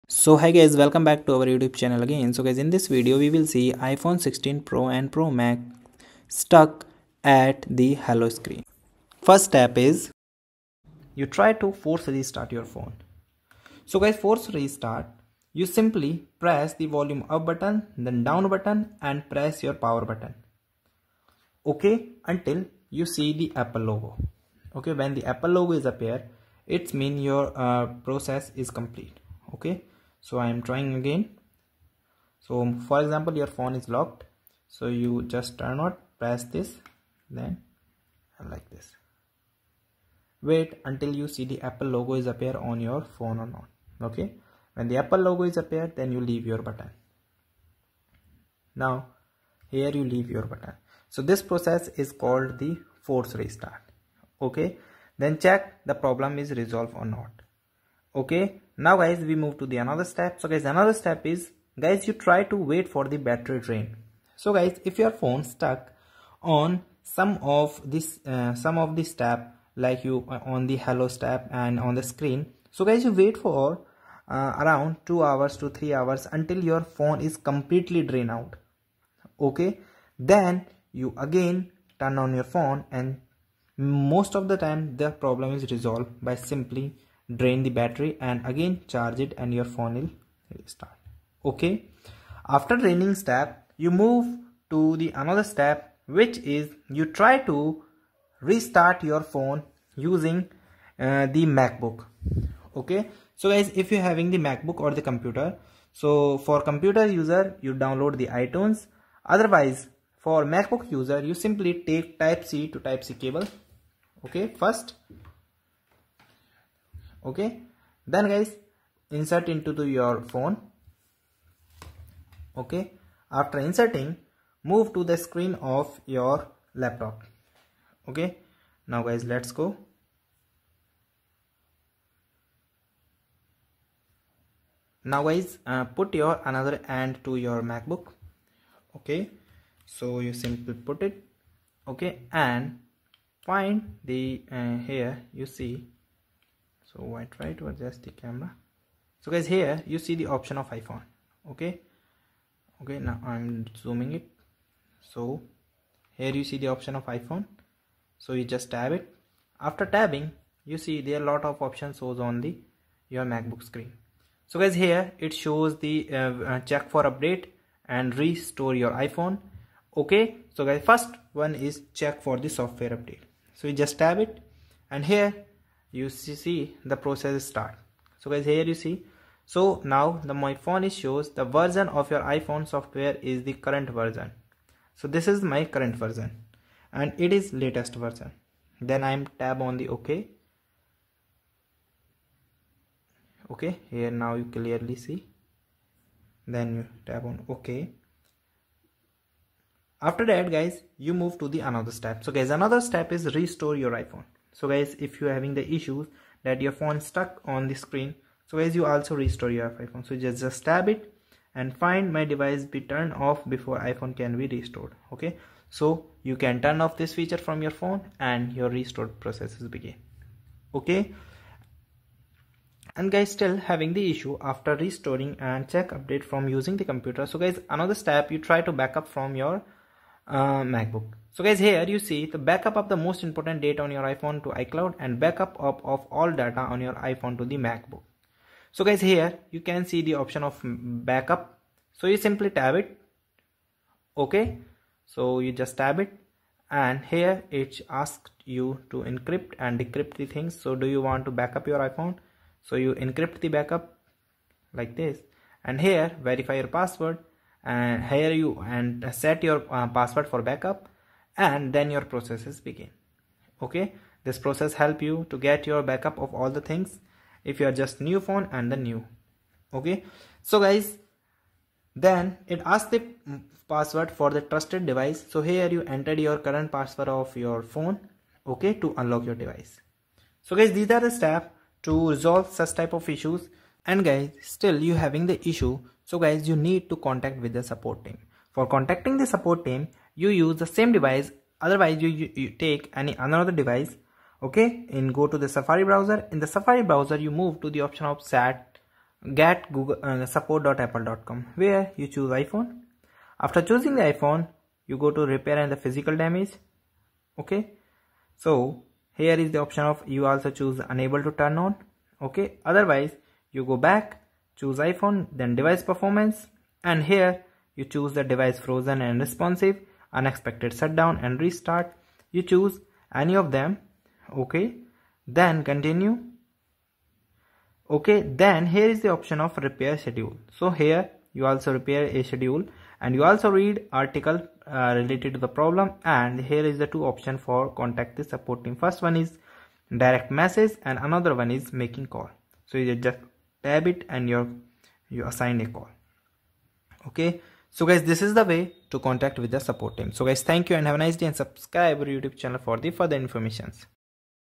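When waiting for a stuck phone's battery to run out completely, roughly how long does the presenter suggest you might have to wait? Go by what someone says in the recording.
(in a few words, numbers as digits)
2 to 3 hours.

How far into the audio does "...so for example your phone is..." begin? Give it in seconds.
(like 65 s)
32 s.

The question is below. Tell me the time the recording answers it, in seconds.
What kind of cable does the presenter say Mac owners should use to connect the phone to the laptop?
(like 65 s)
112 s.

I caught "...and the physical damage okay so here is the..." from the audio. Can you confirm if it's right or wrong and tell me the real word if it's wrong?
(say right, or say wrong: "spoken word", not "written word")
right.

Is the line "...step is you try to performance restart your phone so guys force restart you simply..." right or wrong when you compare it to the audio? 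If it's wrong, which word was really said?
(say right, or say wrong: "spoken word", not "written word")
wrong: "force", not "performance".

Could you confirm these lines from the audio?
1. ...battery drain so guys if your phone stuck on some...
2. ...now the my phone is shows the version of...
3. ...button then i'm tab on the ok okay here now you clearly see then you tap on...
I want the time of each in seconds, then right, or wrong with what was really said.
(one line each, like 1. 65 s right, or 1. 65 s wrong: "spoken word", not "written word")
1. 63 s right
2. 179 s right
3. 187 s wrong: "version", not "button".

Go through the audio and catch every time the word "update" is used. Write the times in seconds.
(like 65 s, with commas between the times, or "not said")
167 s, 172 s, 225 s.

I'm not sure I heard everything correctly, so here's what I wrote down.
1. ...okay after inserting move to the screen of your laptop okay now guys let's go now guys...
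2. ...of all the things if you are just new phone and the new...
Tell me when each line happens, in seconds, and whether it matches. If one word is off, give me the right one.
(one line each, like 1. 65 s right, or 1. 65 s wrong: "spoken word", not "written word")
1. 122 s right
2. 266 s right.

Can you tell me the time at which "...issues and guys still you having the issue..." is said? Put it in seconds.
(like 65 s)
283 s.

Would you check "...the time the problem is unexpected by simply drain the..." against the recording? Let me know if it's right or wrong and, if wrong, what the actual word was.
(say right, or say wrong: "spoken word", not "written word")
wrong: "resolved", not "unexpected".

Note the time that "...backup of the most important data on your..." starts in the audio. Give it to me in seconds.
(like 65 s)
232 s.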